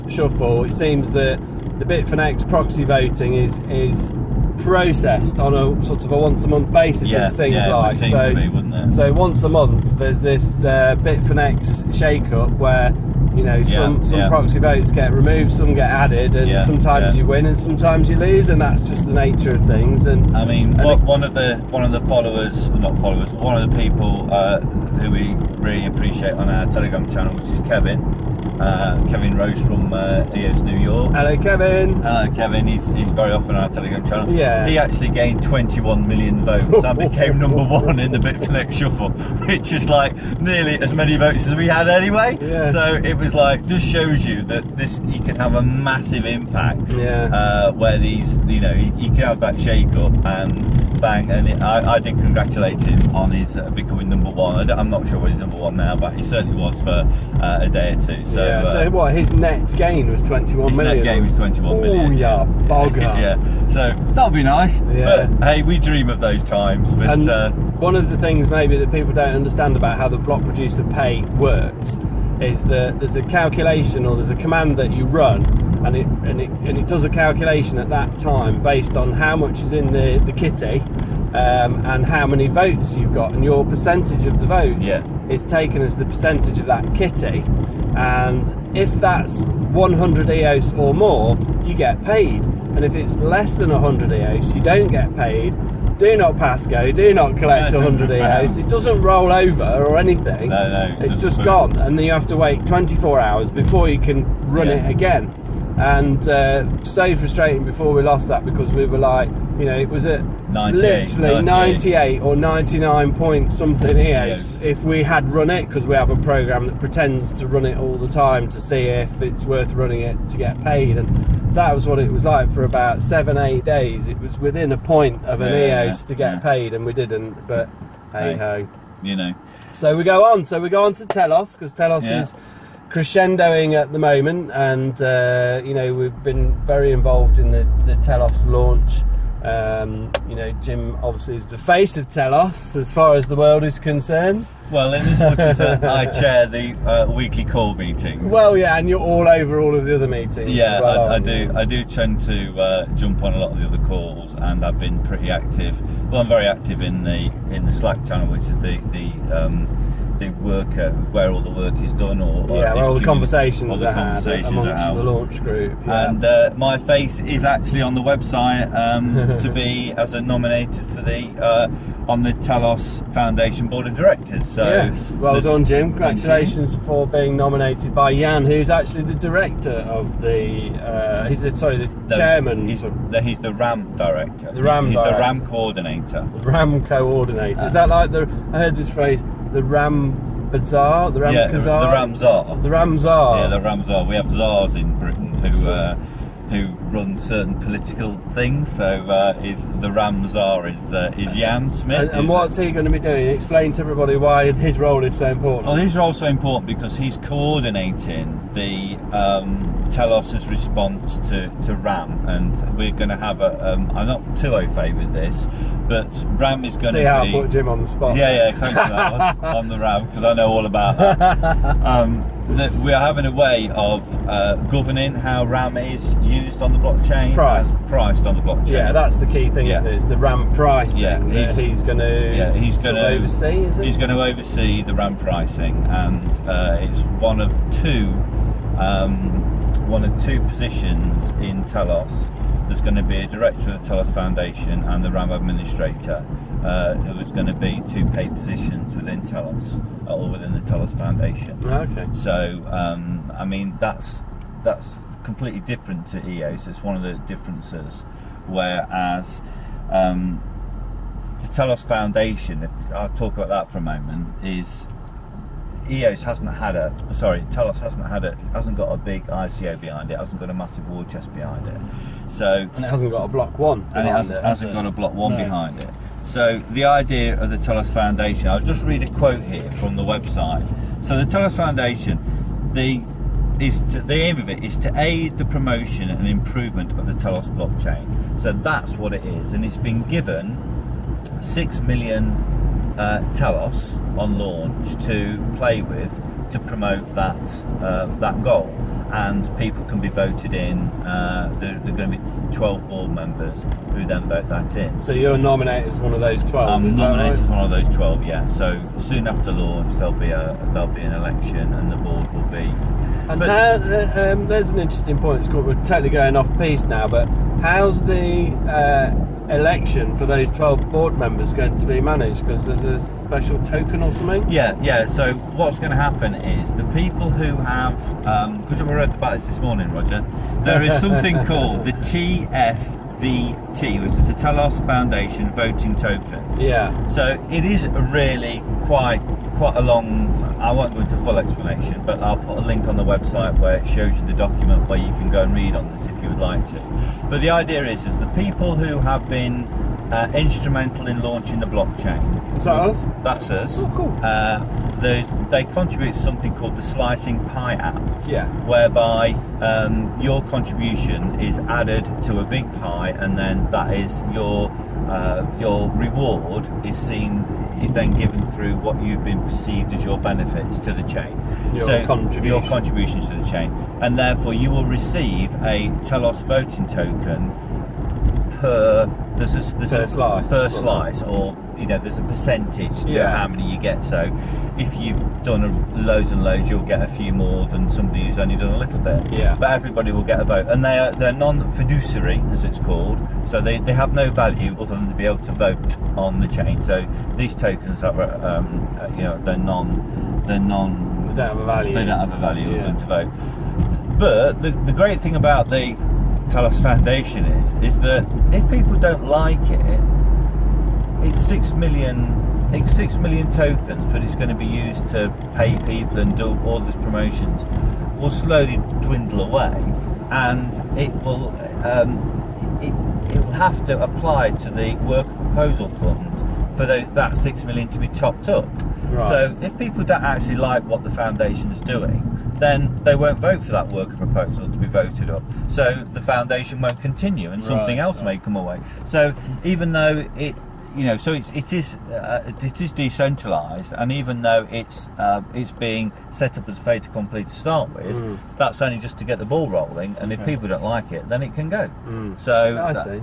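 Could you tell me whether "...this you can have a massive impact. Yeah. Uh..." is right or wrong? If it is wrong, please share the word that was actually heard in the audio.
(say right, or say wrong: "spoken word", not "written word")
right.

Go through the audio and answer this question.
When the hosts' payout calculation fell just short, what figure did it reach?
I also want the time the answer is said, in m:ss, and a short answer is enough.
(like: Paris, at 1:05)
98, at 1:51.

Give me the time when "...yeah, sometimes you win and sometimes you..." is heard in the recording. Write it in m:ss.
0:16.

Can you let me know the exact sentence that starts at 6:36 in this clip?
So these tokens are um, uh, you know they're non they're non they don't have a value.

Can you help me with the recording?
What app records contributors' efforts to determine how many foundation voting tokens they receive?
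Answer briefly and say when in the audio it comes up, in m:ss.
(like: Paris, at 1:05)
Slicing Pie, at 5:56.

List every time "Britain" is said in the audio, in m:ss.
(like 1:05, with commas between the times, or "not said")
3:14.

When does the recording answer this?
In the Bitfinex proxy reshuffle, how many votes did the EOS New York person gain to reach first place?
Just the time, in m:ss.
0:35.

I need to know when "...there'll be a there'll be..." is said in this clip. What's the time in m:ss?
5:09.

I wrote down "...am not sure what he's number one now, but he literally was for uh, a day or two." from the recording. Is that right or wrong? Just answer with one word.
wrong.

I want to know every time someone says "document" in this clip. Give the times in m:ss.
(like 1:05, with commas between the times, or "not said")
5:44.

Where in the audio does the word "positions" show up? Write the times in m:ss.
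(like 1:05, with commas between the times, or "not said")
4:00, 4:08.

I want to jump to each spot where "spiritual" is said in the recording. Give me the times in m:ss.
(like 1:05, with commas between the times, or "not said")
not said.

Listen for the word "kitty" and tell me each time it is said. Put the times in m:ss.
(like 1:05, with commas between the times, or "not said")
1:20, 1:26.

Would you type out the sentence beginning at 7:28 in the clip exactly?
that's only just to get the ball rolling.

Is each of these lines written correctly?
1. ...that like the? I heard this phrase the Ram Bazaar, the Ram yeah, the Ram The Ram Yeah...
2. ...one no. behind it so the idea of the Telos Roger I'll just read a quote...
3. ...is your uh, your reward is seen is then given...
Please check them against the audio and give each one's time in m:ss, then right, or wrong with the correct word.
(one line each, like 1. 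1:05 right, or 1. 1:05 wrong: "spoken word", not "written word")
1. 3:07 right
2. 4:35 wrong: "Foundation", not "Roger"
3. 6:03 right.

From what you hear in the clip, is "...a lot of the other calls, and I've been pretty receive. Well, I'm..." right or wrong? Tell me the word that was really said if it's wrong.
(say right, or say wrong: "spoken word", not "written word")
wrong: "active", not "receive".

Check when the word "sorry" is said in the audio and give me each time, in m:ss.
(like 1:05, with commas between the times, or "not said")
3:01, 4:27.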